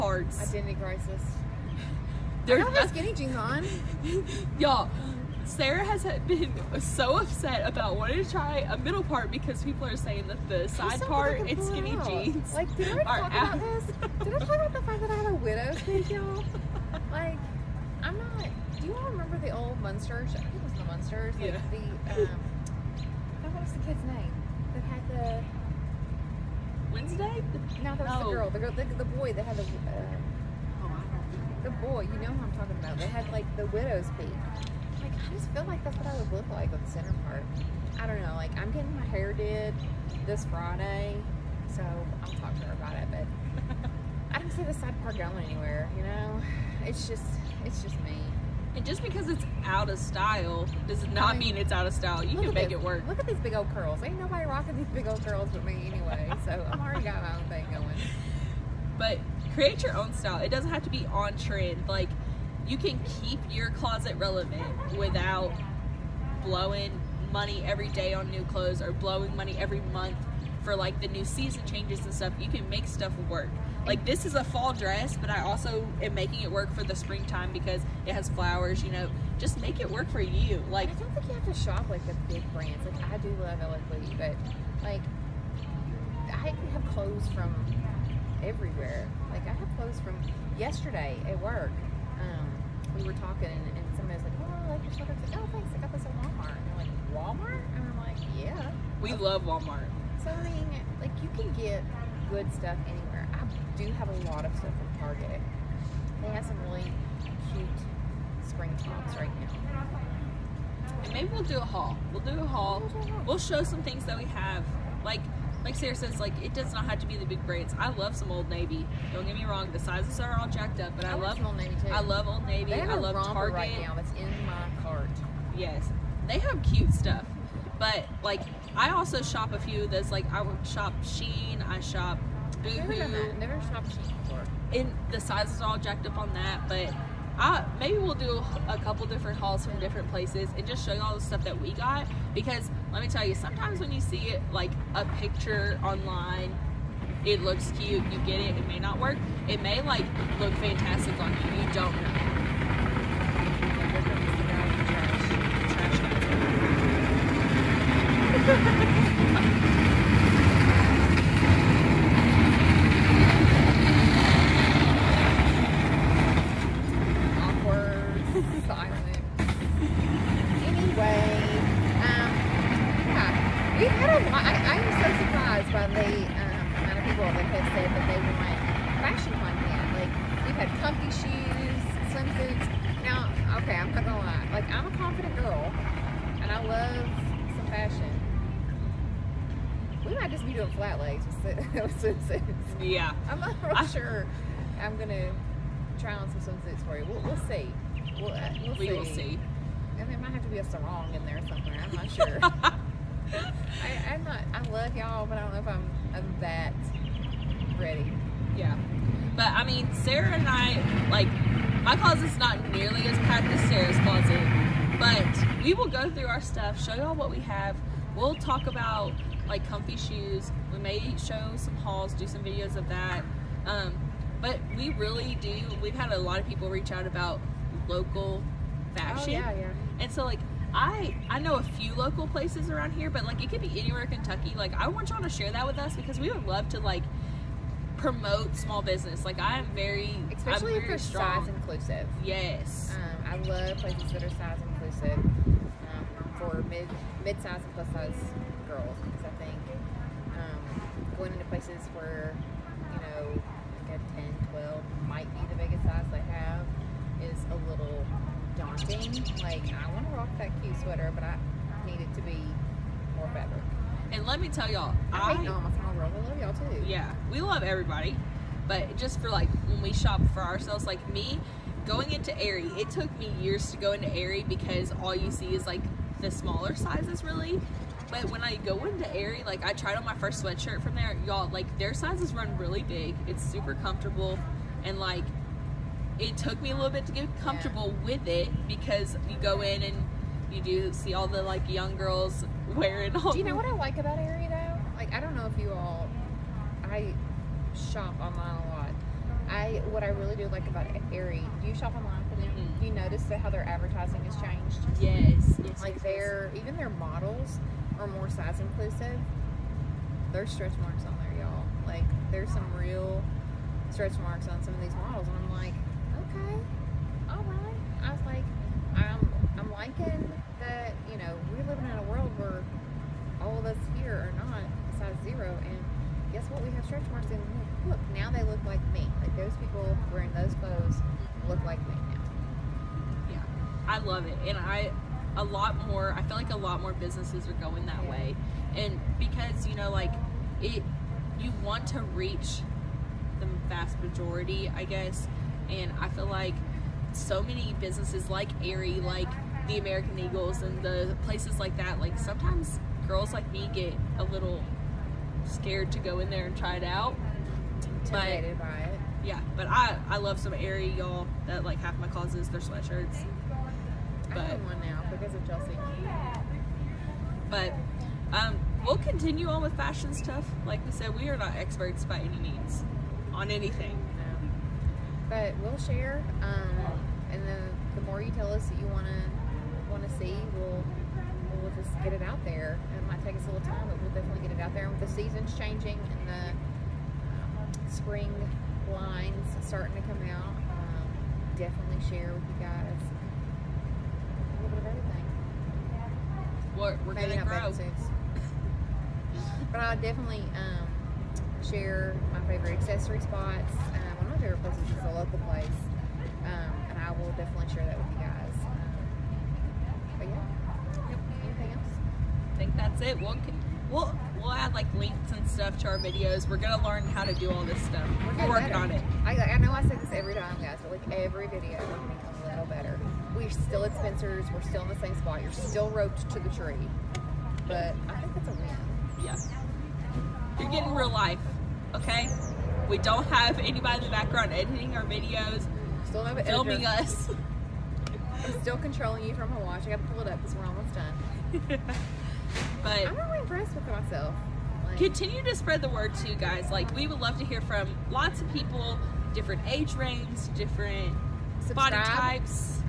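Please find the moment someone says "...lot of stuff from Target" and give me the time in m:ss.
1:44.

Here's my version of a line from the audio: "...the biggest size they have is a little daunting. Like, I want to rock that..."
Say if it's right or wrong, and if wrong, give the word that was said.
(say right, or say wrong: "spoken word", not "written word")
right.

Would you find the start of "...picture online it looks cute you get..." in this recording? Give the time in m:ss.
2:25.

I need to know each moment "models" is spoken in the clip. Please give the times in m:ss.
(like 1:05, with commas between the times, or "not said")
5:06, 5:14.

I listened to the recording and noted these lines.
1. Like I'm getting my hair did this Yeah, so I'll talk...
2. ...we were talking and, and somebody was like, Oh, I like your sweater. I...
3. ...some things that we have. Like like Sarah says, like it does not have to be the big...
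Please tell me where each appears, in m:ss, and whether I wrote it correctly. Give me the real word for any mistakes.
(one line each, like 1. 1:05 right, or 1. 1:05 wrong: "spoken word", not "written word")
1. 0:38 wrong: "Friday", not "Yeah"
2. 1:32 right
3. 1:53 right.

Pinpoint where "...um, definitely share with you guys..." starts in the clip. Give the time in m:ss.
6:30.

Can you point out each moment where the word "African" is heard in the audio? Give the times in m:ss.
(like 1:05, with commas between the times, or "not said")
not said.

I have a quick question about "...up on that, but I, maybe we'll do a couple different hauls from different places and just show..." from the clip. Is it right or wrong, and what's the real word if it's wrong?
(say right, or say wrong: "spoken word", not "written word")
right.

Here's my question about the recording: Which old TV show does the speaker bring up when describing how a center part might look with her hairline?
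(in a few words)
The Munsters.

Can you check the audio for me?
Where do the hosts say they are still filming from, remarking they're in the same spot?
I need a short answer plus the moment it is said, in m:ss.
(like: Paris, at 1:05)
Spencer's, at 7:03.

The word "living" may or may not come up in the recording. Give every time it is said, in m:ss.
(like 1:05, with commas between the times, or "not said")
5:21.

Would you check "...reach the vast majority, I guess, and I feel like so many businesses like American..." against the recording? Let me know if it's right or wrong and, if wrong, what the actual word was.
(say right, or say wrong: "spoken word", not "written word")
wrong: "Aerie", not "American".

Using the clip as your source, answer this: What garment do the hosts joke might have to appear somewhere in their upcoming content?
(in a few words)
A sarong.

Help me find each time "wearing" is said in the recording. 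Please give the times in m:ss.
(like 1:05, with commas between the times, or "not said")
4:52, 5:30.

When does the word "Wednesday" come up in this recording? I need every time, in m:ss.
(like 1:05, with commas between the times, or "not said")
0:26.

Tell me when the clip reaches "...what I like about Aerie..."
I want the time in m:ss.
4:53.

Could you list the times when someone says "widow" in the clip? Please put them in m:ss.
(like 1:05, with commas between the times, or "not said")
0:15, 0:33.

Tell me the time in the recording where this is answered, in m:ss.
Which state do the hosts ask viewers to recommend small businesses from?
3:54.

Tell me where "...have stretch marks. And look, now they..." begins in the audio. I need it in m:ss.
5:26.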